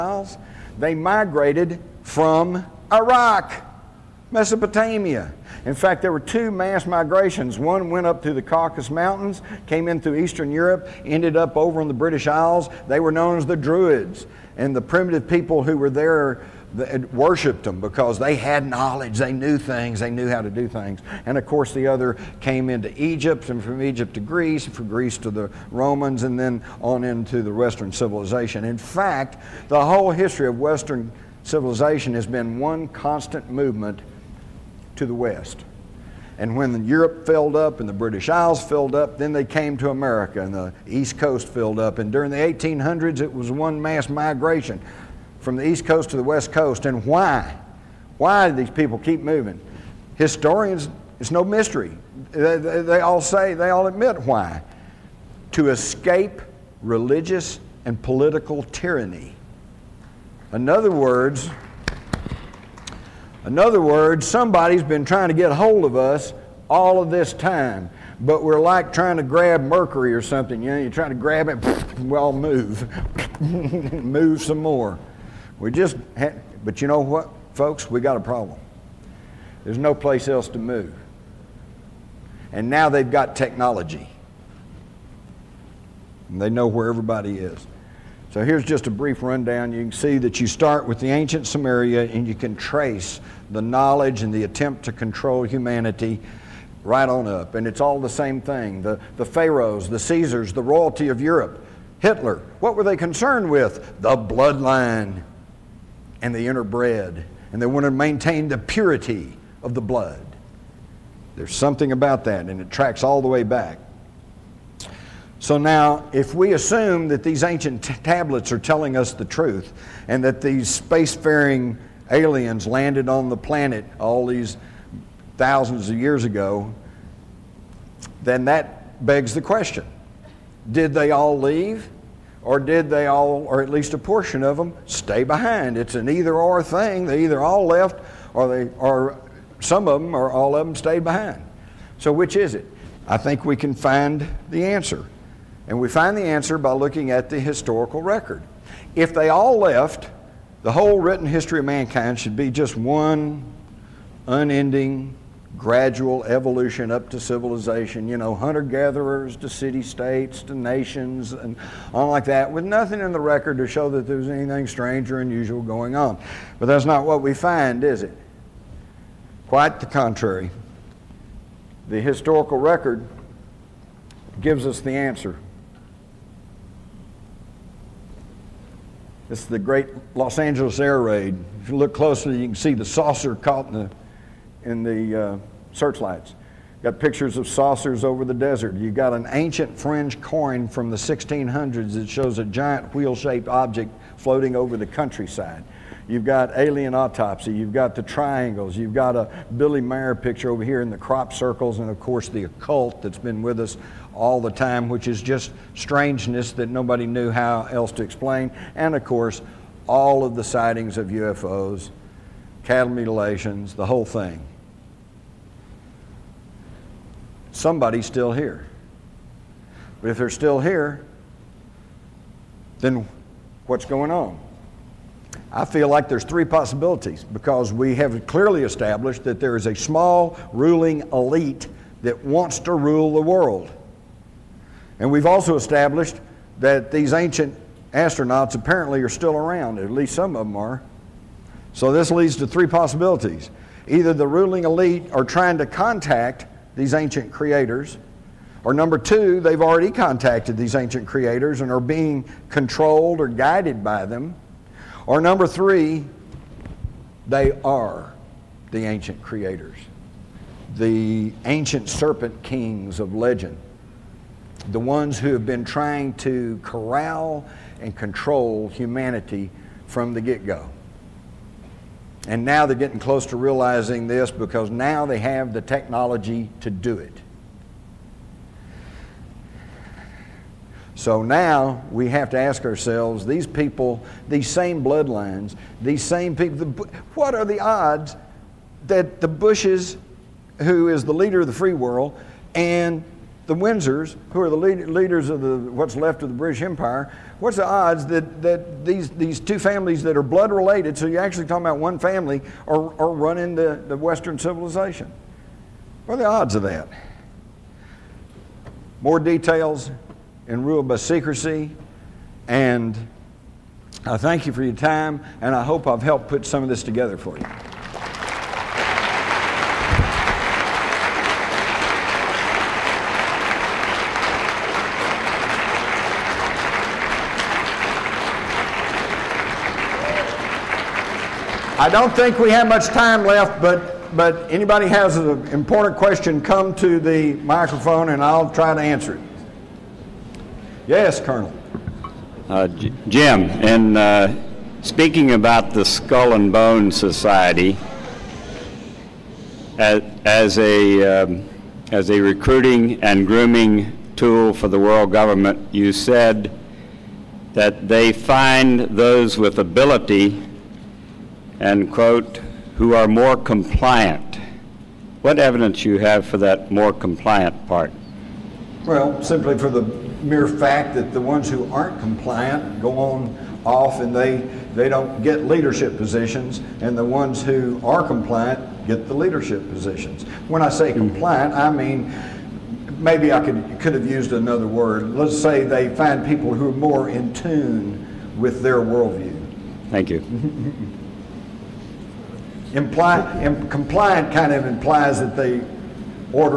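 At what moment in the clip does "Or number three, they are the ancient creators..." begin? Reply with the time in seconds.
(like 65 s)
255 s.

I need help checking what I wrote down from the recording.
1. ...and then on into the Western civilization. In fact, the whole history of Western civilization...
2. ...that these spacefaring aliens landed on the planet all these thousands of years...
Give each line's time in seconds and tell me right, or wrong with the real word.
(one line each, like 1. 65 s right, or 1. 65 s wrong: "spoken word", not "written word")
1. 26 s right
2. 120 s right.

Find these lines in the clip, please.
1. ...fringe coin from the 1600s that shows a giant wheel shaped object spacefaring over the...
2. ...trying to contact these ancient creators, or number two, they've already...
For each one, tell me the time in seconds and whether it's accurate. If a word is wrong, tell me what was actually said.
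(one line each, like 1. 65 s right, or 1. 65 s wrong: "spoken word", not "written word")
1. 189 s wrong: "floating", not "spacefaring"
2. 245 s right.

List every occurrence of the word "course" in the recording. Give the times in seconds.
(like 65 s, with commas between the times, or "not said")
21 s, 202 s, 209 s.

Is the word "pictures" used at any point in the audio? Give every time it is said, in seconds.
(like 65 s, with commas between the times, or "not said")
186 s, 200 s.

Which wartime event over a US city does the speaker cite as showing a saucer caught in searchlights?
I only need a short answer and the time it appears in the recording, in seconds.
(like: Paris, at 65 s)
The great Los Angeles air raid, at 179 s.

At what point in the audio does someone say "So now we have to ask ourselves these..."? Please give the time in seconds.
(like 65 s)
280 s.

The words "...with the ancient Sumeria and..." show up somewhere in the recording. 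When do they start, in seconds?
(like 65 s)
90 s.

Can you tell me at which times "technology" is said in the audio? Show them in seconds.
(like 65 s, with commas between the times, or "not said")
83 s, 275 s.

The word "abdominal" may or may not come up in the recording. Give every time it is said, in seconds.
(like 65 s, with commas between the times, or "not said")
not said.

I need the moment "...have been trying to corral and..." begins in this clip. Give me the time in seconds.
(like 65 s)
265 s.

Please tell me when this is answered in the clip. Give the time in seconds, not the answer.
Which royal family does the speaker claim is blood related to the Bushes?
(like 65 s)
293 s.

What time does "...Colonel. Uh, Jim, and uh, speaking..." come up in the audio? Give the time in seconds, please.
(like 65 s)
341 s.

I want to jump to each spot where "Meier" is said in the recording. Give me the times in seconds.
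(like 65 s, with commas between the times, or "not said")
199 s.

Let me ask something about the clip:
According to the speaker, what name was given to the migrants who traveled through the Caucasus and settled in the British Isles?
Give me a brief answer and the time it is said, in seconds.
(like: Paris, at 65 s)
Druids, at 13 s.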